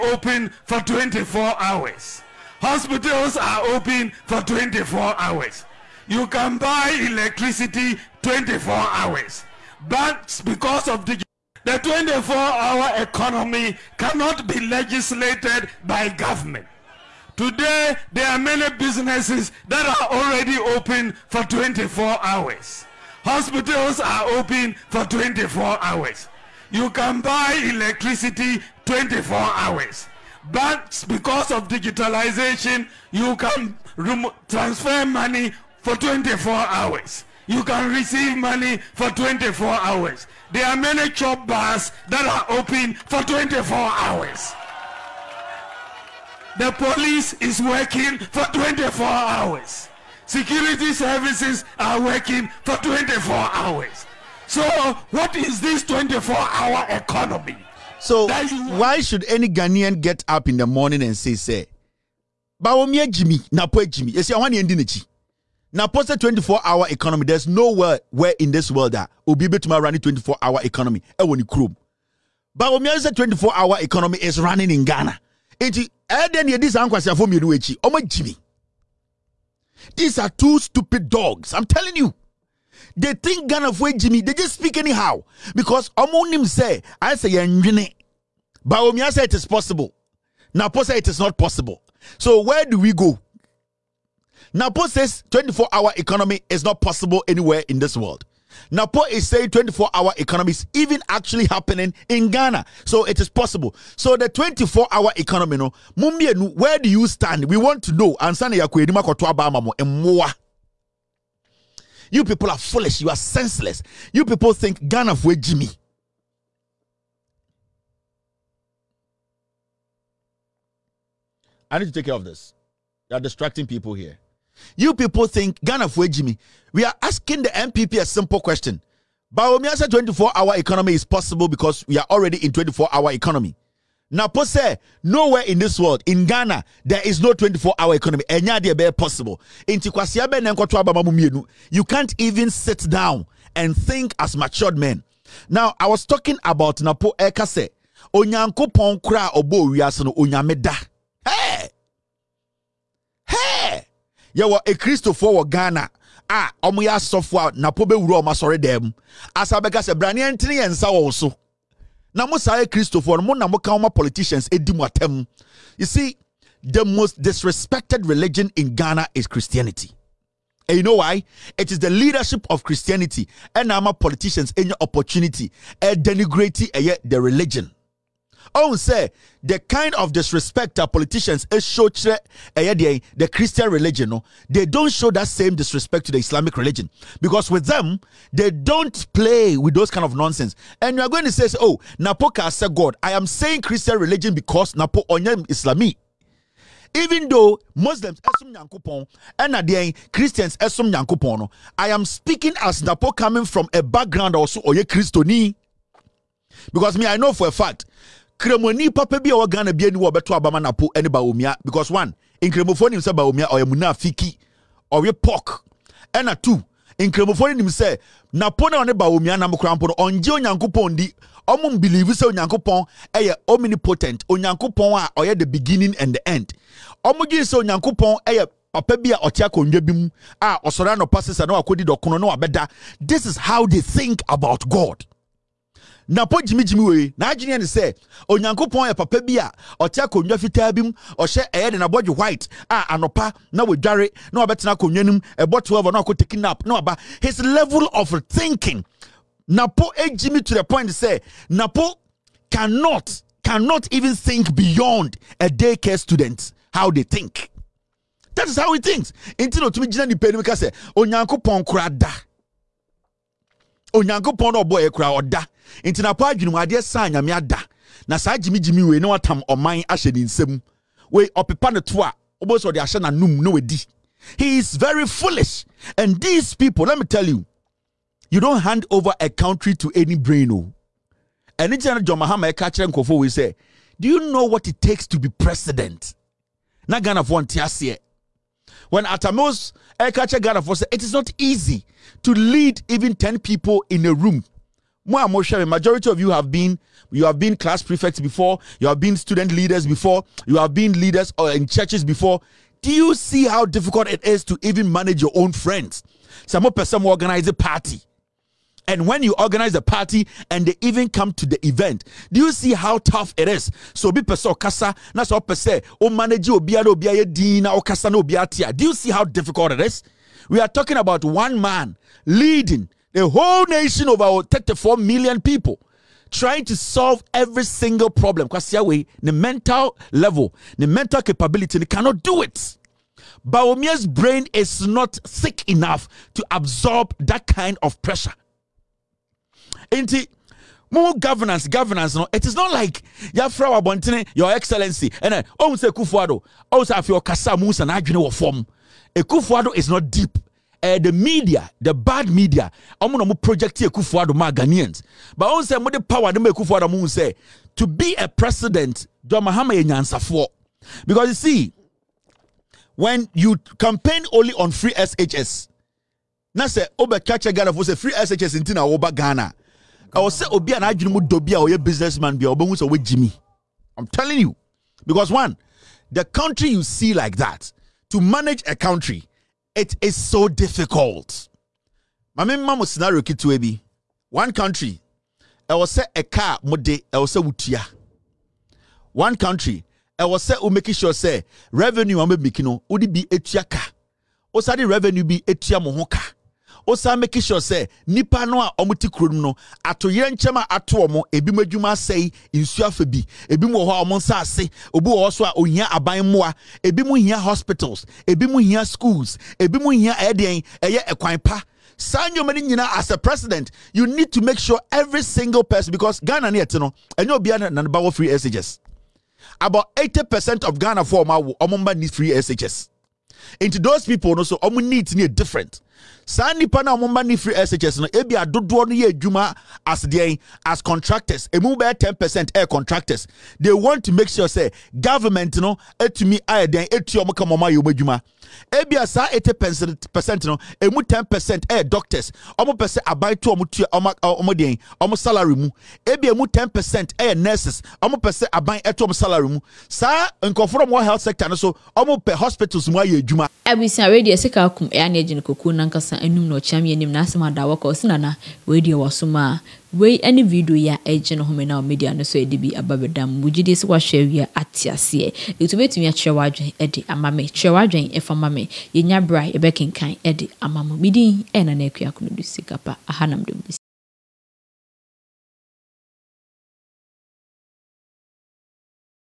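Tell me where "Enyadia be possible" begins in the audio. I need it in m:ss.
2:18.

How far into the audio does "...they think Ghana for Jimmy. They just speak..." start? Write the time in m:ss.
1:22.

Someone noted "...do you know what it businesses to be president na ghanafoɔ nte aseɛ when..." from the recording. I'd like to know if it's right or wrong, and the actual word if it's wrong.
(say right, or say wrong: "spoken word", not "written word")
wrong: "takes", not "businesses".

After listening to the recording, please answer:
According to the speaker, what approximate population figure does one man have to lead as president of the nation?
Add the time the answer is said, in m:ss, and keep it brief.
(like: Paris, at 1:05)
34 million, at 5:24.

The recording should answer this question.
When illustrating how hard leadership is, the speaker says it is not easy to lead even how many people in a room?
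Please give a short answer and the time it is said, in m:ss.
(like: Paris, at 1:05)
10, at 4:53.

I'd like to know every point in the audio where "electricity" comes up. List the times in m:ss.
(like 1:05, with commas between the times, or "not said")
0:07, 0:27.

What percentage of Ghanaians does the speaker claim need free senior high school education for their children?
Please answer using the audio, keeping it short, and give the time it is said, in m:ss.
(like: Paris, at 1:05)
80 percent, at 6:59.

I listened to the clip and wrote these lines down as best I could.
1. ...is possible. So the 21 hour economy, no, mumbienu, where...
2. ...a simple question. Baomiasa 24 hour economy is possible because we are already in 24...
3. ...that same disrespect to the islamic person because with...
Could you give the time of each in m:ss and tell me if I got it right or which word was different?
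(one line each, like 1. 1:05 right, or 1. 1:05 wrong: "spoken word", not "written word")
1. 1:43 wrong: "24", not "21"
2. 2:07 right
3. 3:05 wrong: "religion", not "person".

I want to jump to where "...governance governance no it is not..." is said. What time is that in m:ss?
5:41.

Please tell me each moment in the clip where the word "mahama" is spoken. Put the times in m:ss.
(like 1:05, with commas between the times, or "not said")
4:42, 5:59.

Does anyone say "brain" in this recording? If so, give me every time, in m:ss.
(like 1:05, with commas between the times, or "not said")
4:40, 5:34.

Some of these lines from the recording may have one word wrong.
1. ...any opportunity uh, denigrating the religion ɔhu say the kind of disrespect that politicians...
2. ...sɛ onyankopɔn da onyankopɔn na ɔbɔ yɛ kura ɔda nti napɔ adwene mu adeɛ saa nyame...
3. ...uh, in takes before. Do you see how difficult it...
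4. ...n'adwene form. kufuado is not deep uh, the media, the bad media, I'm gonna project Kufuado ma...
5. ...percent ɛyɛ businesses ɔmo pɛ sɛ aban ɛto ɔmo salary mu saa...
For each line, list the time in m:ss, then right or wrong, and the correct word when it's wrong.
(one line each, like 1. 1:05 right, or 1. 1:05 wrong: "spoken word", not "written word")
1. 2:54 right
2. 4:20 right
3. 5:01 wrong: "churches", not "takes"
4. 5:47 right
5. 7:26 wrong: "nurses", not "businesses".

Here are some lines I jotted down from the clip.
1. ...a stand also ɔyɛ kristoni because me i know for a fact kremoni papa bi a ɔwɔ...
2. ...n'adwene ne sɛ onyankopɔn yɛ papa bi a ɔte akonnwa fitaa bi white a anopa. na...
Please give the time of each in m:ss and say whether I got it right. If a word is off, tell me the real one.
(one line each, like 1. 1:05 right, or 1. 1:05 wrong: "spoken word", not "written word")
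1. 3:23 wrong: "background", not "stand"
2. 3:57 right.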